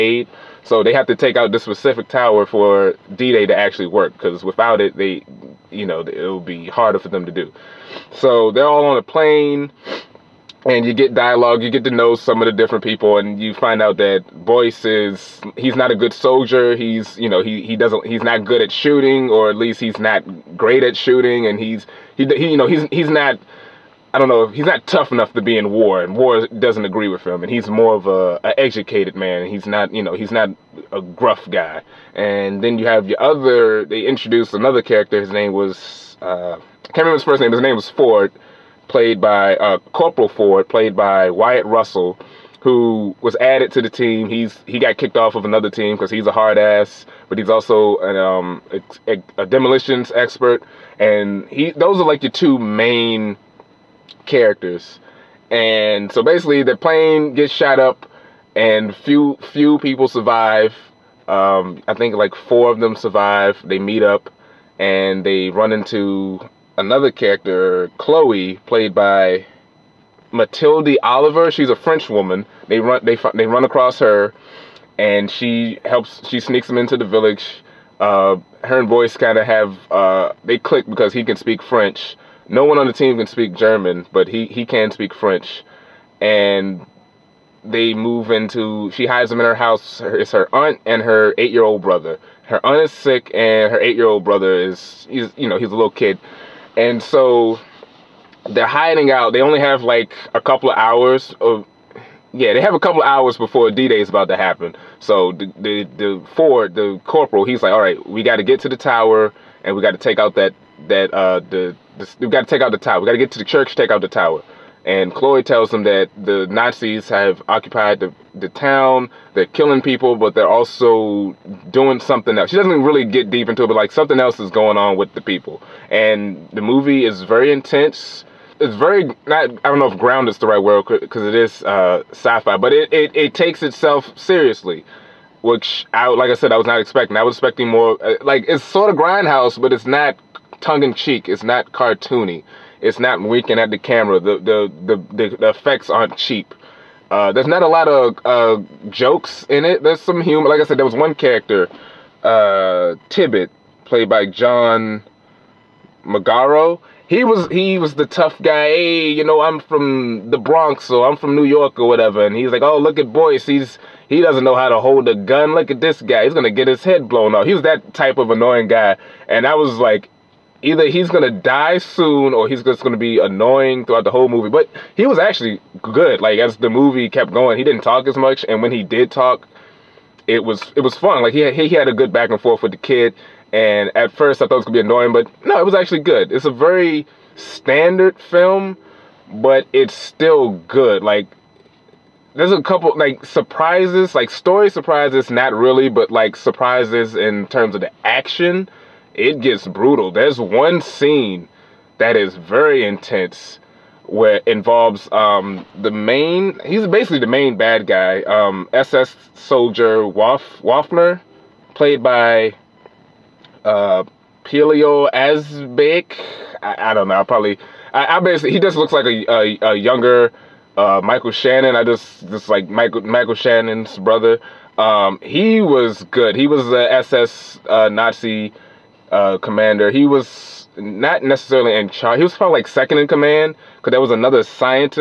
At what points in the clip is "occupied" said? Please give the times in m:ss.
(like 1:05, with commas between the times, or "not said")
1:57.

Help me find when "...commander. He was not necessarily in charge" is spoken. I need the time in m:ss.
3:49.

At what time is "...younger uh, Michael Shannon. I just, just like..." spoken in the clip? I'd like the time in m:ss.
3:39.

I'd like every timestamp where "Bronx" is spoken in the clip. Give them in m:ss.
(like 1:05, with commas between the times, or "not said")
2:40.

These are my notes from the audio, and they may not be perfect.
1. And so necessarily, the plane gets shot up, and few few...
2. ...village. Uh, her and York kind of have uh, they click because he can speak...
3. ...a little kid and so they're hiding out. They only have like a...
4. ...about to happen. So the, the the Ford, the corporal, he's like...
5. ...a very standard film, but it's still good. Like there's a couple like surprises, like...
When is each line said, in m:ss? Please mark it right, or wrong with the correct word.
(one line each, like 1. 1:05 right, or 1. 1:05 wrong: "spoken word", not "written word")
1. 0:55 wrong: "basically", not "necessarily"
2. 1:17 wrong: "Boyce", not "York"
3. 1:35 right
4. 1:44 right
5. 3:06 right.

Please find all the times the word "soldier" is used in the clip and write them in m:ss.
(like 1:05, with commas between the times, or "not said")
0:16, 3:29.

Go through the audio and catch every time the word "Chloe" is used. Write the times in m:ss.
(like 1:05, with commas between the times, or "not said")
1:07, 1:55.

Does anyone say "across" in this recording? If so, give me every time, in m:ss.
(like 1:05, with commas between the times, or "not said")
1:13.